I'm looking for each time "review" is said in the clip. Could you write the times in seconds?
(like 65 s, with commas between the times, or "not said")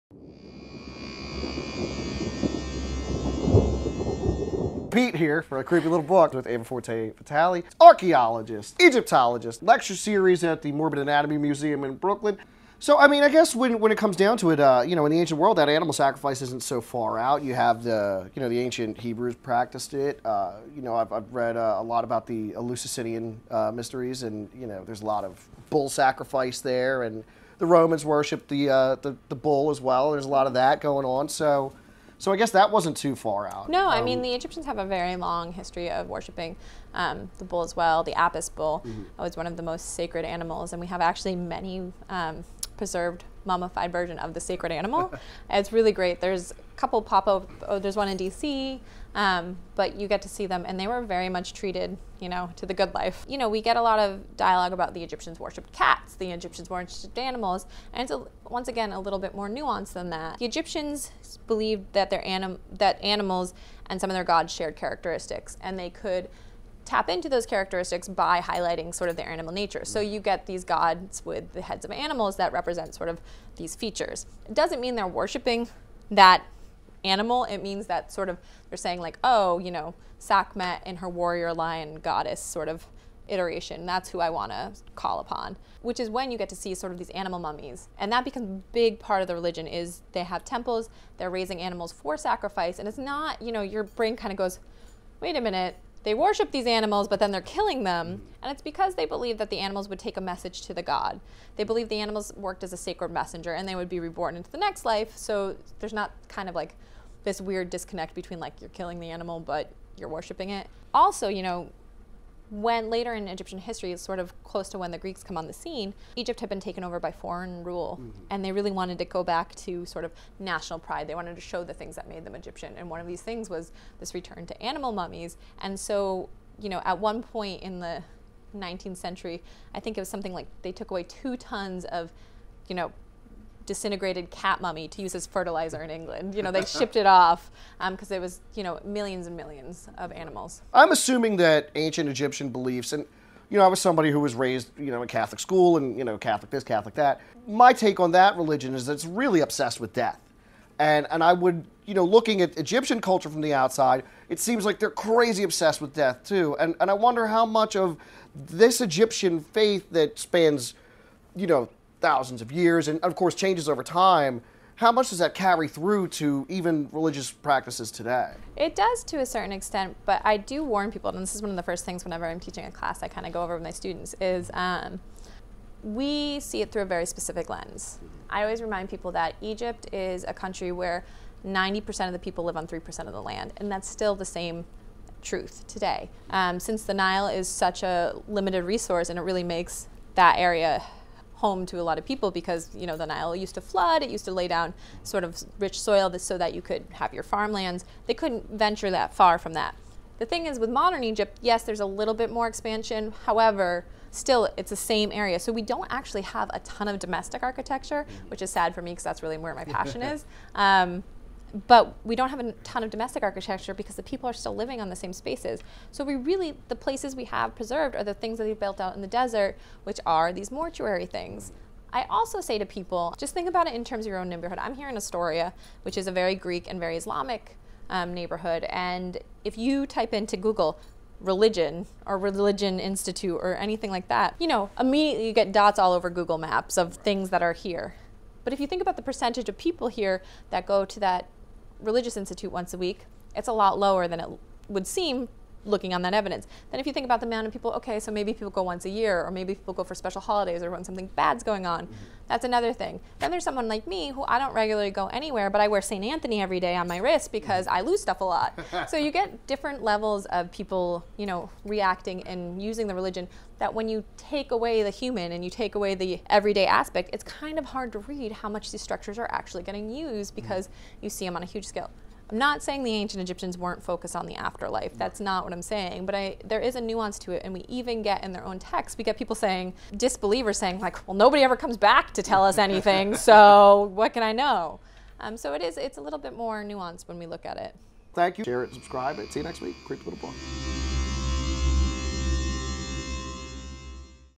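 not said.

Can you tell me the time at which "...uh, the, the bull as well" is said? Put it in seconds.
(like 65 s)
28 s.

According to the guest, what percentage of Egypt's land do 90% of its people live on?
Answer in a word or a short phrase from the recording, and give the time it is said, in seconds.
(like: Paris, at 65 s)
3%, at 182 s.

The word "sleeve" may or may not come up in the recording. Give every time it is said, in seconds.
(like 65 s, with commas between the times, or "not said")
not said.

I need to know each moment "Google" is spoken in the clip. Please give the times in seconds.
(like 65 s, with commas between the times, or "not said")
230 s, 236 s.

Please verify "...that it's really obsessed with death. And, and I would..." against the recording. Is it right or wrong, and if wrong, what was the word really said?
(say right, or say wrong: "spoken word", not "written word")
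right.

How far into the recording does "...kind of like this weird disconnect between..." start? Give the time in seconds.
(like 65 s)
106 s.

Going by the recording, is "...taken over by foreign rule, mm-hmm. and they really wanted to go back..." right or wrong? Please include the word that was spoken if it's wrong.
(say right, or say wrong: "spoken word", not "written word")
right.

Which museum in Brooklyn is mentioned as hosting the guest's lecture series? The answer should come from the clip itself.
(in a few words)
Morbid Anatomy Museum.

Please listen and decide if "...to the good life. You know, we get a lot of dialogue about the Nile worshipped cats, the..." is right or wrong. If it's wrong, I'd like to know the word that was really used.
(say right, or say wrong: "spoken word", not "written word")
wrong: "Egyptians", not "Nile".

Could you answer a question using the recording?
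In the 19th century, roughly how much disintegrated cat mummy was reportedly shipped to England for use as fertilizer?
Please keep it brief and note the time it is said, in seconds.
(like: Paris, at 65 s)
2 tons, at 131 s.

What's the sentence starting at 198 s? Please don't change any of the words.
They couldn't venture that far from that.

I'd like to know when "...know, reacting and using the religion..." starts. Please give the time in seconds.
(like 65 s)
261 s.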